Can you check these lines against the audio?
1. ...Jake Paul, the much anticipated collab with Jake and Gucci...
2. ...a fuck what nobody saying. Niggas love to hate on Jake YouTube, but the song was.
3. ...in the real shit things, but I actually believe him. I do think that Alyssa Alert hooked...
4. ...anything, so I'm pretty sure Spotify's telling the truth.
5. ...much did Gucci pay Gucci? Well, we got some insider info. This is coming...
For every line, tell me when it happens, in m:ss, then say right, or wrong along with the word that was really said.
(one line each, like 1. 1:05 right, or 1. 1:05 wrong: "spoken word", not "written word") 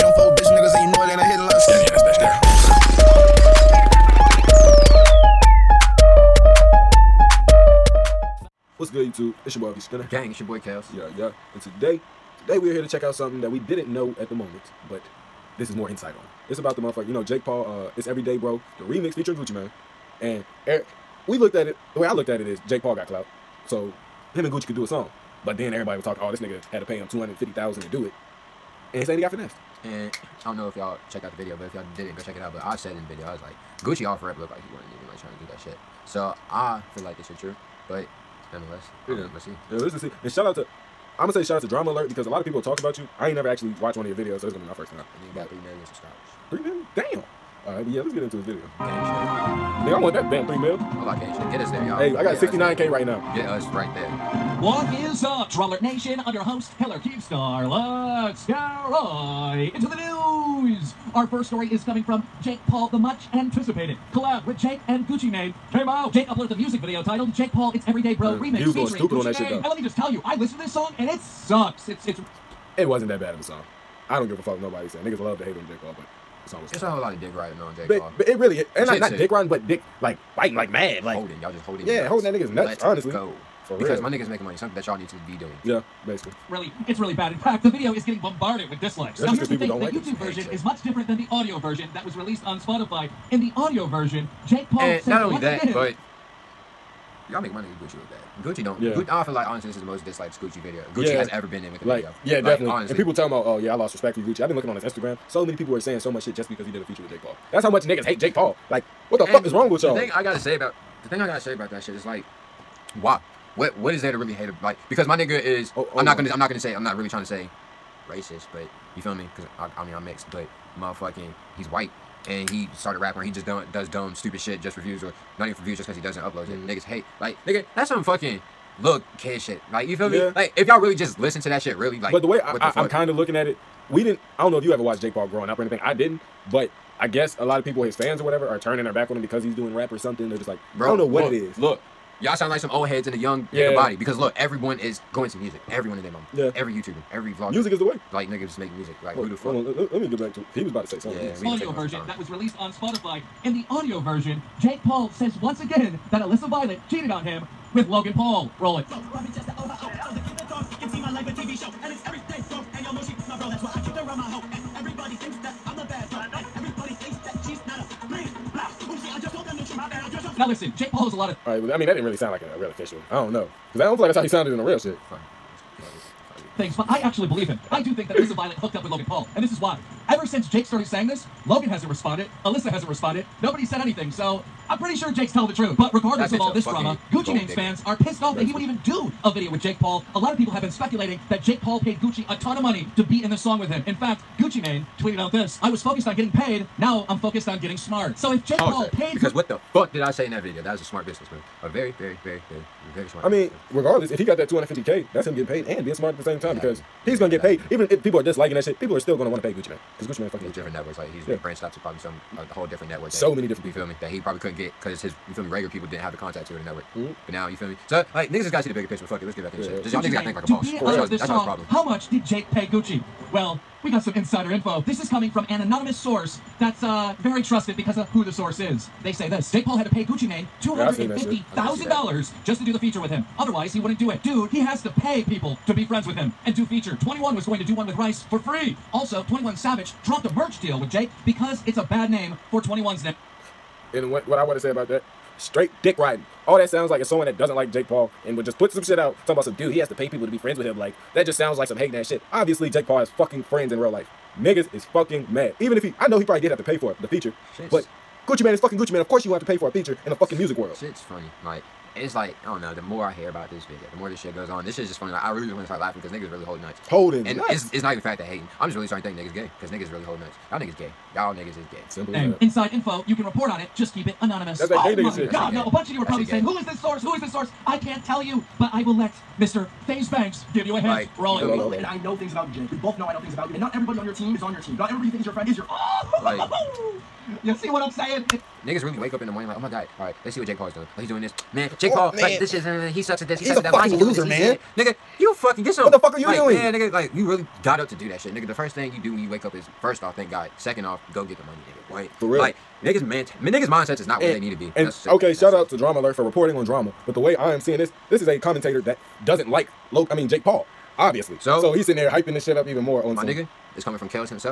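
1. 1:02 right
2. 1:14 wrong: "Paul", not "YouTube"
3. 2:54 wrong: "Violet", not "Alert"
4. 3:03 wrong: "Jake", not "Spotify"
5. 3:41 wrong: "Jake", not "Gucci".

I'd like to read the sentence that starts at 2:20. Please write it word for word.
They're just like, bro, I don't know what look, it is.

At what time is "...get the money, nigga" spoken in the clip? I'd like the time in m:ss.
5:01.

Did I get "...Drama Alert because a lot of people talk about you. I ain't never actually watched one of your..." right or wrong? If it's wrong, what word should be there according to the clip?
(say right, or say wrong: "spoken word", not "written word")
right.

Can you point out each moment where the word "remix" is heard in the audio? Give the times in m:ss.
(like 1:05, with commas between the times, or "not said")
0:18, 1:08.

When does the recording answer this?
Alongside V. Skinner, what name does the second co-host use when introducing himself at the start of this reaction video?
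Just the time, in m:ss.
0:10.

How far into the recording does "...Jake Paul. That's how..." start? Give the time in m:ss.
1:47.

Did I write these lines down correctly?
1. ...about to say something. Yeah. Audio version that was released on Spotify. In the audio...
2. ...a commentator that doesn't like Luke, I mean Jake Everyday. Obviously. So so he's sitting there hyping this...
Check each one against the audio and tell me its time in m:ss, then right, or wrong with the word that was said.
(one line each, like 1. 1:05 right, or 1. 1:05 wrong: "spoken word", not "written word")
1. 2:30 right
2. 5:08 wrong: "Paul", not "Everyday".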